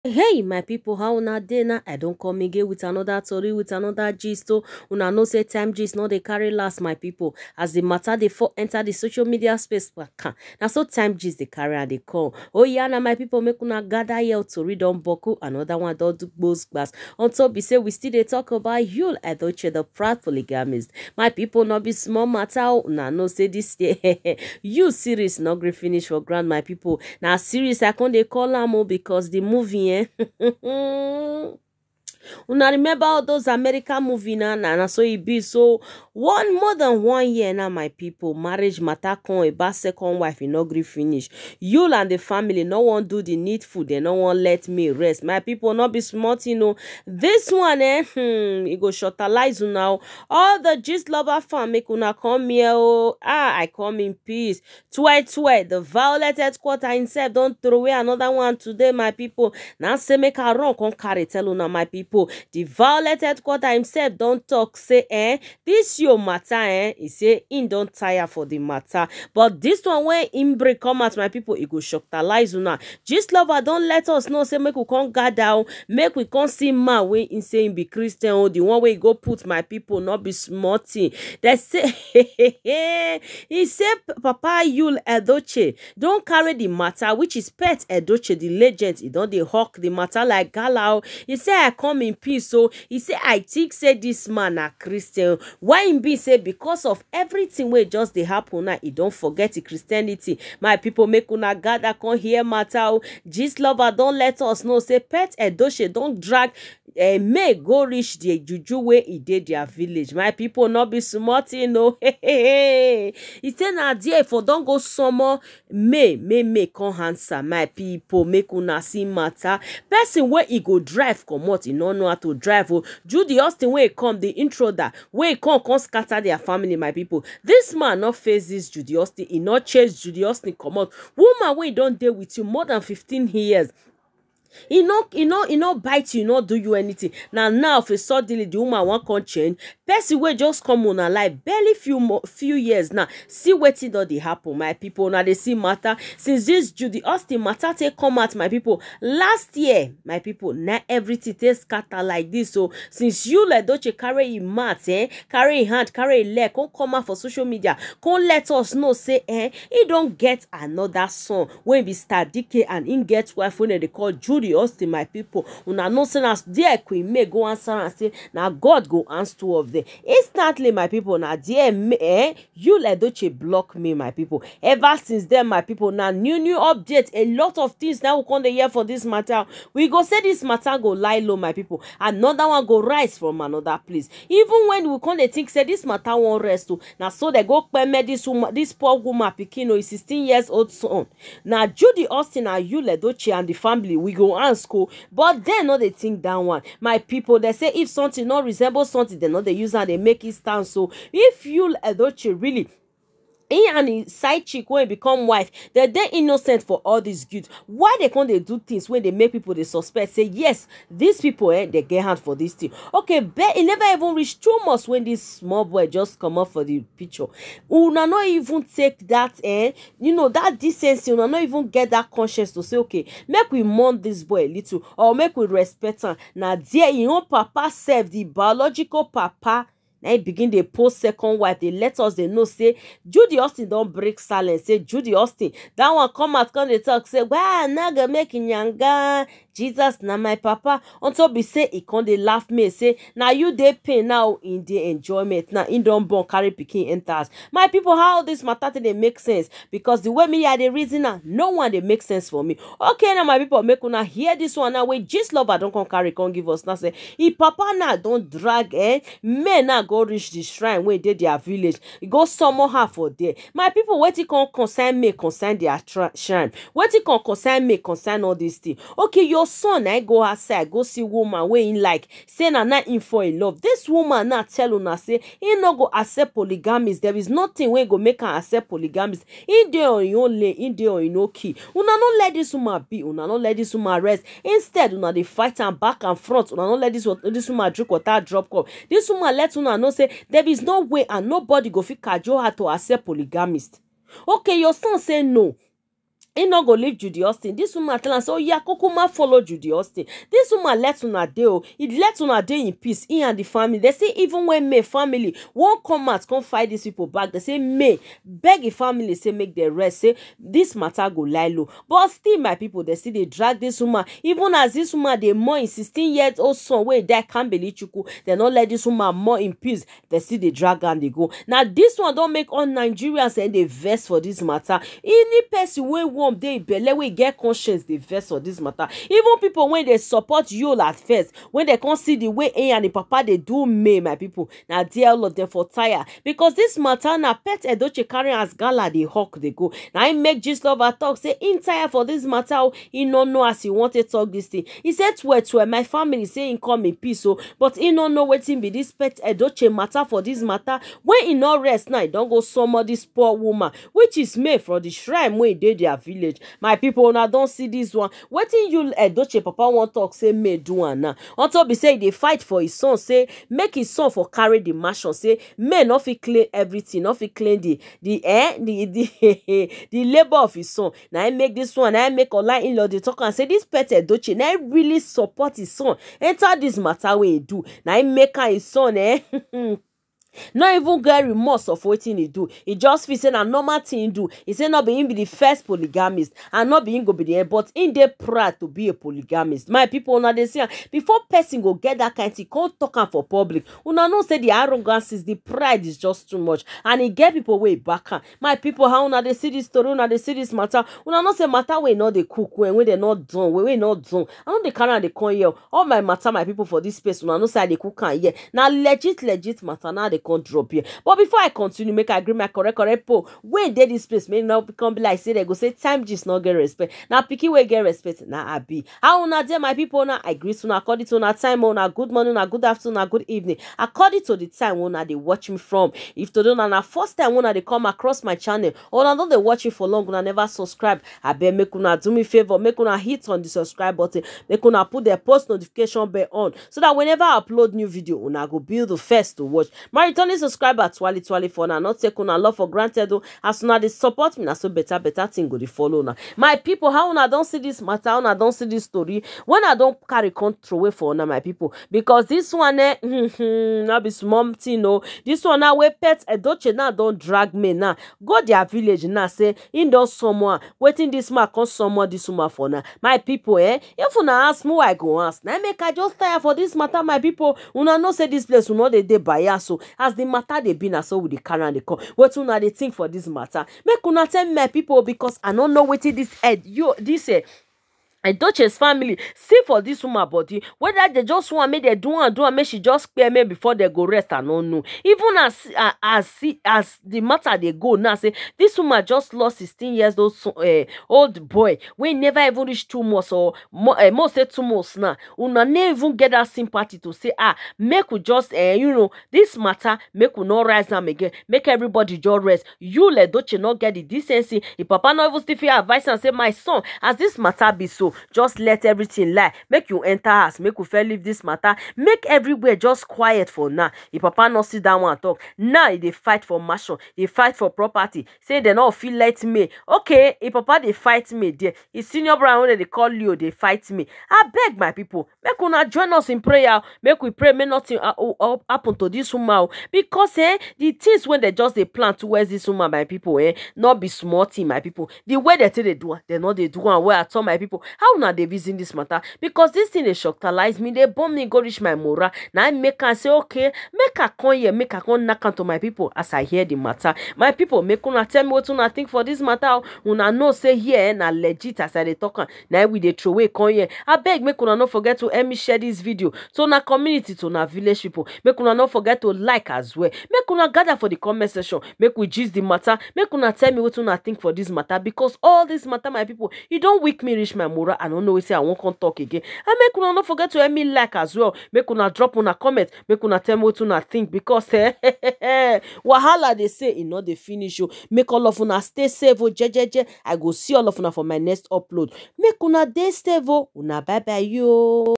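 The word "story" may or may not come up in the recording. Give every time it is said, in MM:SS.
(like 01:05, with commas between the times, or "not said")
00:03, 06:39, 07:28.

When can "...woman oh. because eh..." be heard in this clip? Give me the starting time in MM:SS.
08:49.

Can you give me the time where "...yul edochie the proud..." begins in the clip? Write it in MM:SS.
00:18.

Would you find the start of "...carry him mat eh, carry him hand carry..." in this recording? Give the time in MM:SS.
02:33.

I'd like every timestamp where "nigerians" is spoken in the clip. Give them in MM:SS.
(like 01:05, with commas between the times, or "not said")
05:22.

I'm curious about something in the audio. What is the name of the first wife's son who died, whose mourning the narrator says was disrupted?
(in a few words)
Kambelichukwu.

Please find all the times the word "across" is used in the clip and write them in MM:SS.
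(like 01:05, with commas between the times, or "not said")
07:07.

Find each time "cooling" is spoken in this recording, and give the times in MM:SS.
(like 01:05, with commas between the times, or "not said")
not said.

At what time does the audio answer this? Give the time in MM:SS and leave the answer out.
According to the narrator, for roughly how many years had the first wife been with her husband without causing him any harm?
02:12.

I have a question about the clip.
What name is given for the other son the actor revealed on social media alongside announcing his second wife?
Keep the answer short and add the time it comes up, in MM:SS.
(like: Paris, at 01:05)
Star DK, at 02:41.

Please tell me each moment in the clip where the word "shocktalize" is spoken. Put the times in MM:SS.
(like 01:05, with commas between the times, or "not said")
01:11, 09:00.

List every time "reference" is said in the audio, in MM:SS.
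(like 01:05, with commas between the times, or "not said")
not said.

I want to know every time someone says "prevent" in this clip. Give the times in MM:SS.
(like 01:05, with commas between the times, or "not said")
not said.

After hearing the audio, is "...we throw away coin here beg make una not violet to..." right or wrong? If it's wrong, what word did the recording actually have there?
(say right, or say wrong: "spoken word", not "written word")
wrong: "forget", not "violet".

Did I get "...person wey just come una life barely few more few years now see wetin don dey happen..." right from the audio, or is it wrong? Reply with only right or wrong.
right.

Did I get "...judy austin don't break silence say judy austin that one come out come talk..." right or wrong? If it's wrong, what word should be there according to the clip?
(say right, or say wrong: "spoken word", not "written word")
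right.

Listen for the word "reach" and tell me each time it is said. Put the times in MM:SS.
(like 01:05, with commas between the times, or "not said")
01:47, 03:34, 04:20, 08:12, 09:01, 09:27.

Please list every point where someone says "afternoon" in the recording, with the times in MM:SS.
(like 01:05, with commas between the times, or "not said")
07:02.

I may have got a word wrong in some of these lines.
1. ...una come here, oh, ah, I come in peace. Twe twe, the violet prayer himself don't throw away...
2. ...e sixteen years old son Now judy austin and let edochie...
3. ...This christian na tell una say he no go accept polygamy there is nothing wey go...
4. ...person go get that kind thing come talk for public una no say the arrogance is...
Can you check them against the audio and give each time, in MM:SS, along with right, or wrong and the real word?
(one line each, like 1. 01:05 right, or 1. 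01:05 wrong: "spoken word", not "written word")
1. 00:51 wrong: "headquarter", not "prayer"
2. 03:09 right
3. 04:33 wrong: "woman", not "christian"
4. 06:31 right.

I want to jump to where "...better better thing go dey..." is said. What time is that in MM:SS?
07:24.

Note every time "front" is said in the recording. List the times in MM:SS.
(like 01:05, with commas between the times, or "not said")
04:46.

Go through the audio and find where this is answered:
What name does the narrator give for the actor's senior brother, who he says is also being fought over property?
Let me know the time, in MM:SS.
08:43.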